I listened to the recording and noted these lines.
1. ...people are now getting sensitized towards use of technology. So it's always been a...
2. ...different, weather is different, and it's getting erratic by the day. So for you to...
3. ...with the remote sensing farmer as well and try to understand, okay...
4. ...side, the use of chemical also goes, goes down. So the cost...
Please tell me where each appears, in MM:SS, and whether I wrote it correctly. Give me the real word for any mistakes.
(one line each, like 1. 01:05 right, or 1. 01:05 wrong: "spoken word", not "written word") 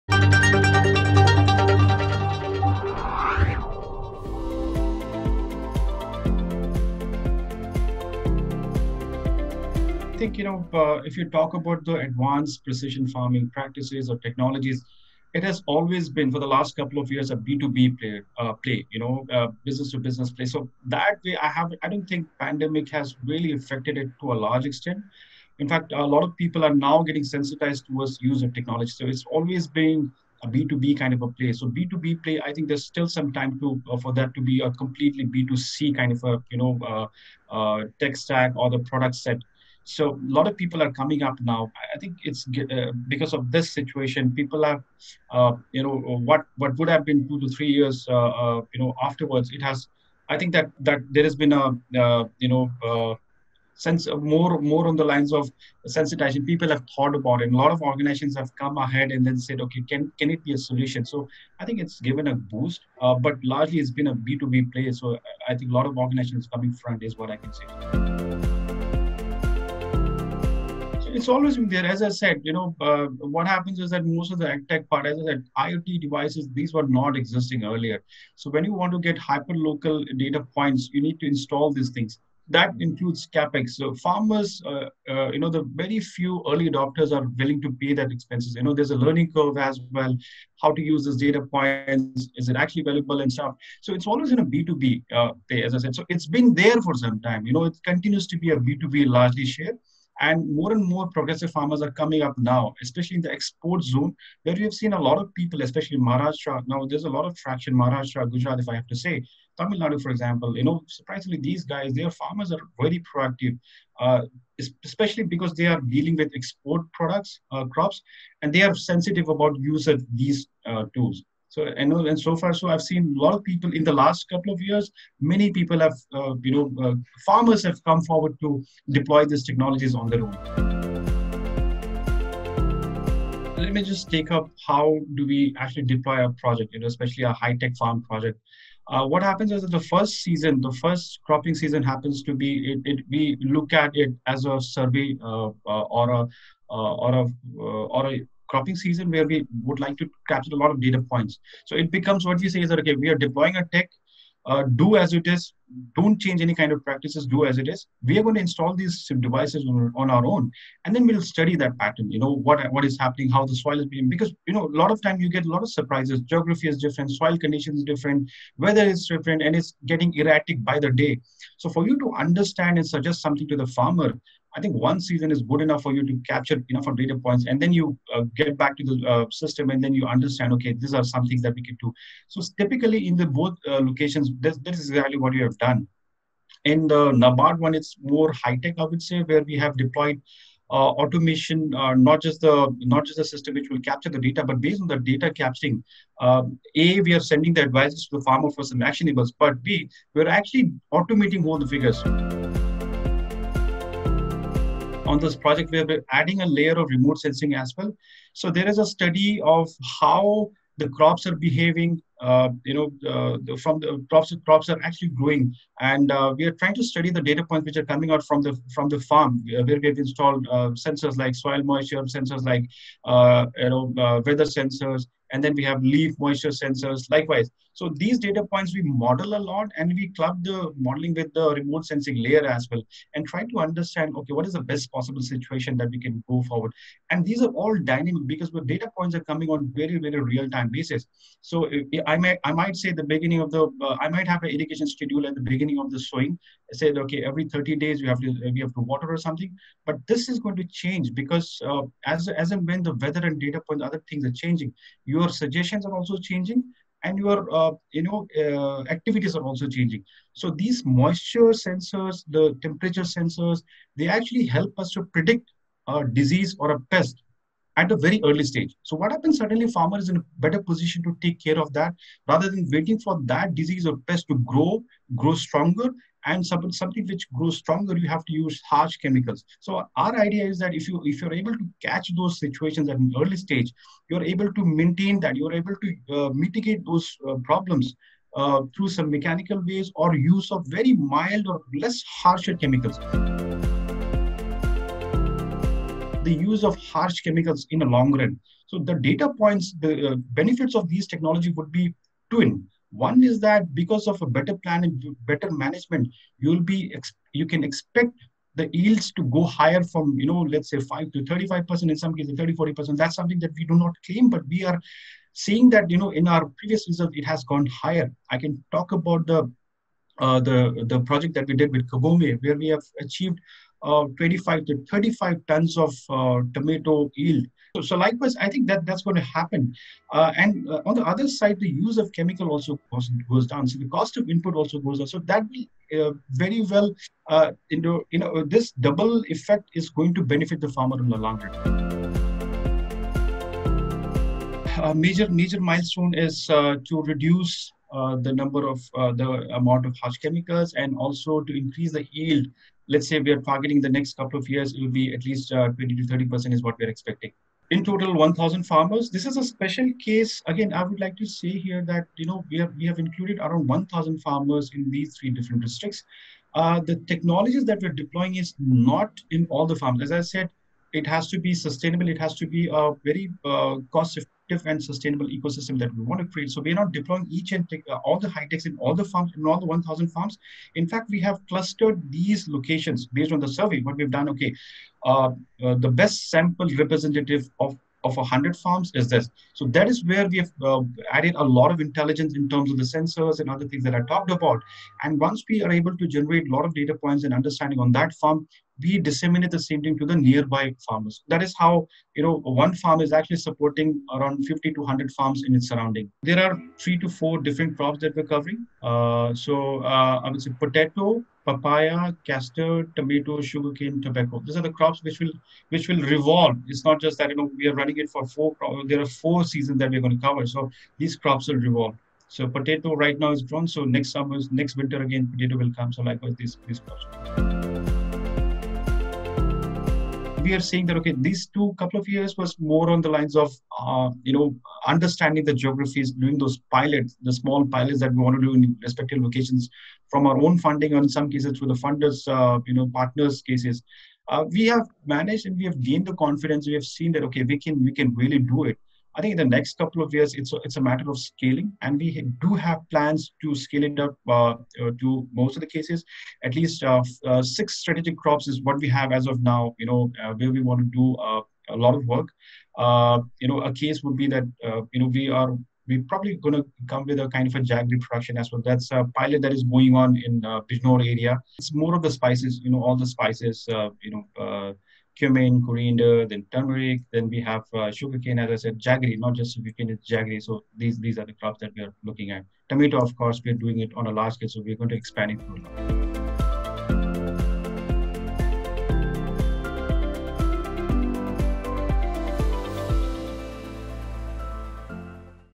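1. 00:26 right
2. 02:47 right
3. 03:51 wrong: "layer", not "farmer"
4. 05:31 right.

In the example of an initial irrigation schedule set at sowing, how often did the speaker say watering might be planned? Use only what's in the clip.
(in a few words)
every 30 days.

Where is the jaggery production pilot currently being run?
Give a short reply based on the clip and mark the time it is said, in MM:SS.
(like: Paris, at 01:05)
Bijnor, at 07:50.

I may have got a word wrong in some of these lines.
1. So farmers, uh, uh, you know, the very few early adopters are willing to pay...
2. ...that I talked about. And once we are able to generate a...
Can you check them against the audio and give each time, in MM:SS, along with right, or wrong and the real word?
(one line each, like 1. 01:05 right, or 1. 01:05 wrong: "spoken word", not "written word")
1. 01:23 right
2. 06:33 right.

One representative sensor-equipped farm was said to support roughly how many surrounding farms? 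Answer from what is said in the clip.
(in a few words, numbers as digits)
50 to 100.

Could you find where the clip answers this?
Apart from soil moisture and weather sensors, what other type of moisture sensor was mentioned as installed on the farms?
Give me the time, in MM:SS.
03:45.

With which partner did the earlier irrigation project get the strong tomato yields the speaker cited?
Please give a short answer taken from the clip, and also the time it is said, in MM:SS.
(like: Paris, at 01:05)
Kabome, at 05:21.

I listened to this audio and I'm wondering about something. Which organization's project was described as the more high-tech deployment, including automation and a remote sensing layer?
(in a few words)
Nabard.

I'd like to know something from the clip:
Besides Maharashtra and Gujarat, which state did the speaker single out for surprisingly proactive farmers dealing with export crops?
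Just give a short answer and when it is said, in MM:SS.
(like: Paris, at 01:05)
Tamil Nadu, at 01:49.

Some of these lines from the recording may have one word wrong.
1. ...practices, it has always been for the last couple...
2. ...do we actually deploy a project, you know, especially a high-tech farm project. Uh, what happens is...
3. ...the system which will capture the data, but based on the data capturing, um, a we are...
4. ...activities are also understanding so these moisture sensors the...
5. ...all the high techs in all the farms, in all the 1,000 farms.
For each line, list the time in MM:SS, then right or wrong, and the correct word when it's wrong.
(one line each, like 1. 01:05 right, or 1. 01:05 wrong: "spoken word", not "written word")
1. 00:14 wrong: "technologies", not "practices"
2. 02:15 right
3. 03:13 right
4. 04:18 wrong: "changing", not "understanding"
5. 06:18 right.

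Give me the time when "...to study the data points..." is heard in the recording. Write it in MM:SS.
03:36.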